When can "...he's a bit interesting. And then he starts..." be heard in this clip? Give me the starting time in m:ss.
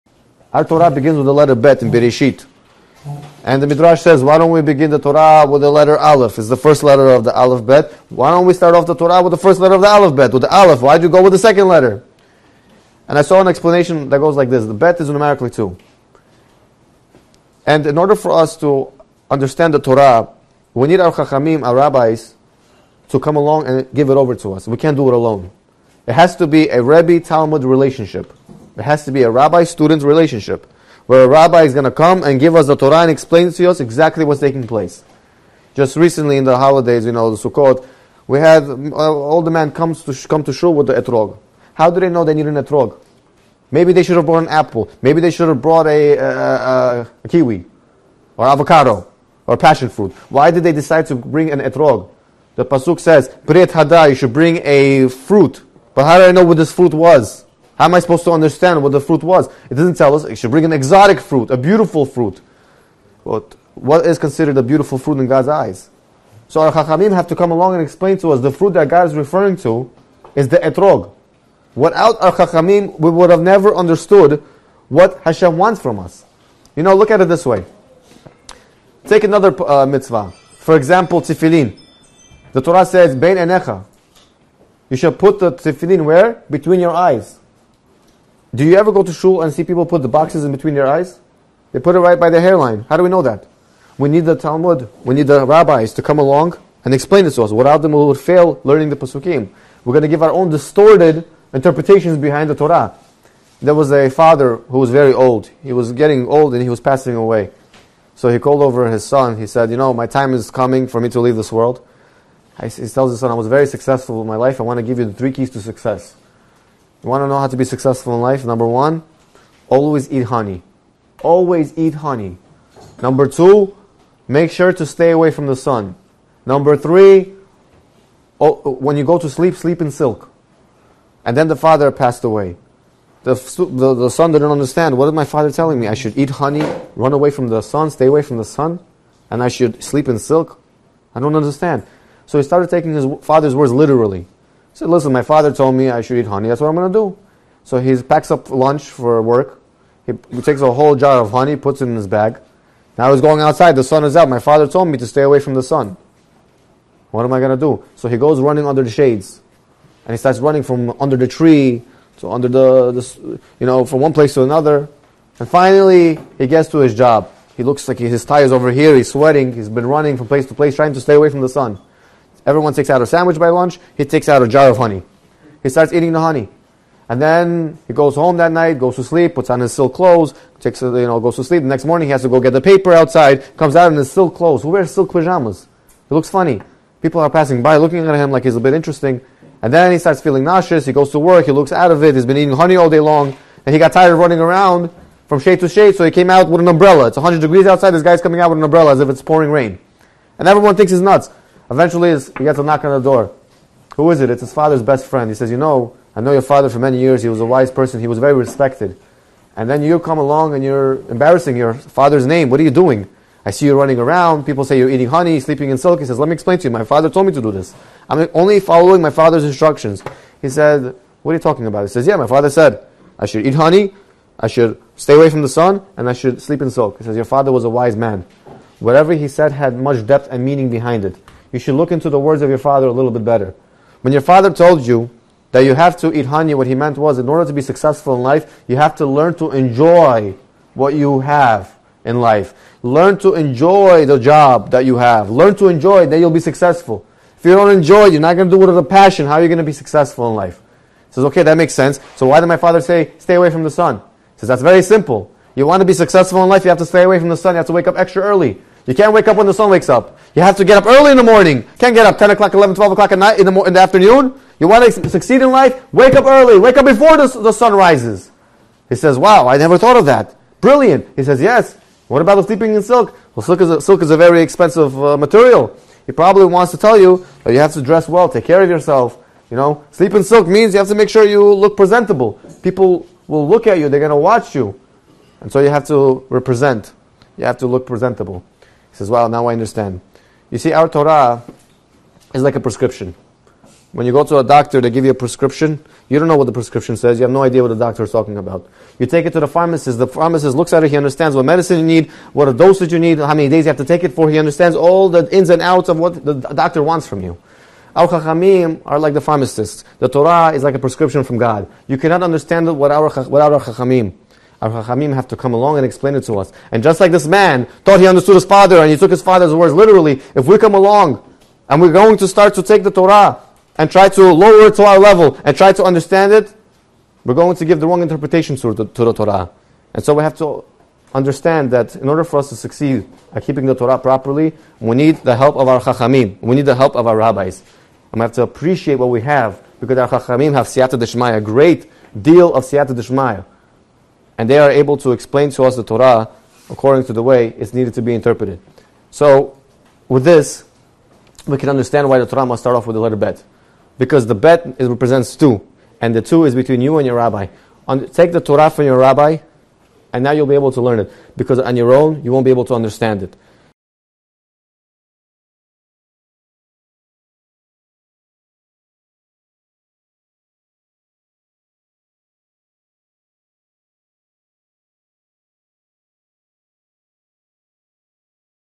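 3:08.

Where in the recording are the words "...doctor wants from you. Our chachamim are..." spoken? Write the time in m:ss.
5:06.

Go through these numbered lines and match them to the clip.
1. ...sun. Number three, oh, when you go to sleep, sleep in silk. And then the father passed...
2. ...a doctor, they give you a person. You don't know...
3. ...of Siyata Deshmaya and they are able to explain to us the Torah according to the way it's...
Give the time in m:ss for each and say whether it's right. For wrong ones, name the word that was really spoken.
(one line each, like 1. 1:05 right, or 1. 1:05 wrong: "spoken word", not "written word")
1. 2:05 right
2. 4:54 wrong: "prescription", not "person"
3. 5:42 right.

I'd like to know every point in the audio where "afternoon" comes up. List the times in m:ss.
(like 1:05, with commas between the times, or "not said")
4:23.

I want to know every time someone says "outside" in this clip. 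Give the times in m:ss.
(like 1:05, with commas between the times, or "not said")
2:33, 3:02, 3:17.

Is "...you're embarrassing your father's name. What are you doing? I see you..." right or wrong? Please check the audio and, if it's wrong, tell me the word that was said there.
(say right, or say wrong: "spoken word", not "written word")
right.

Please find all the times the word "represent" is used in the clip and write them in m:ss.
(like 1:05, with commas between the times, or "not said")
4:46, 5:54.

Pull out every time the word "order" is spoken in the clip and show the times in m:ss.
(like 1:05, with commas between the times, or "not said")
0:17, 3:57, 5:32.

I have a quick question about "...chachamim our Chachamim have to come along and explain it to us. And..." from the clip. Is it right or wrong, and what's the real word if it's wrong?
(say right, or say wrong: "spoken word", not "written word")
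right.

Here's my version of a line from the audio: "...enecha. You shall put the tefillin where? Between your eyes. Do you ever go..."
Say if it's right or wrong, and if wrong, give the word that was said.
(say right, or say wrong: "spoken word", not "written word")
right.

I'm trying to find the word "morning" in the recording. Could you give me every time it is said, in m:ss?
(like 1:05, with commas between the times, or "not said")
3:01, 4:21.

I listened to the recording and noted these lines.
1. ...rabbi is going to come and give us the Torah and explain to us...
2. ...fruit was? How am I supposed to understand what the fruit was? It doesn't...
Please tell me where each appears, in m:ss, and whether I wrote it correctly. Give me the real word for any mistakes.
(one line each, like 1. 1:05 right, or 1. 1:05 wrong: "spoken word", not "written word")
1. 0:31 right
2. 0:56 right.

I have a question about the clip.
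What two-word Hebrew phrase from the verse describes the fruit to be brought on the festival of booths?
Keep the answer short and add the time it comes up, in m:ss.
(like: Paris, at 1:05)
Pri hadar, at 0:53.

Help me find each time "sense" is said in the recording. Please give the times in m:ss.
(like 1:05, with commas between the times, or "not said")
4:11.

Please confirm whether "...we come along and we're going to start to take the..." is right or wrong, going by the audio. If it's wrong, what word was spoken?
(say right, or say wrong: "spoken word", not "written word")
right.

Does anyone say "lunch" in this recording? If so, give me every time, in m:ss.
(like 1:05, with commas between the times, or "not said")
2:28, 2:53.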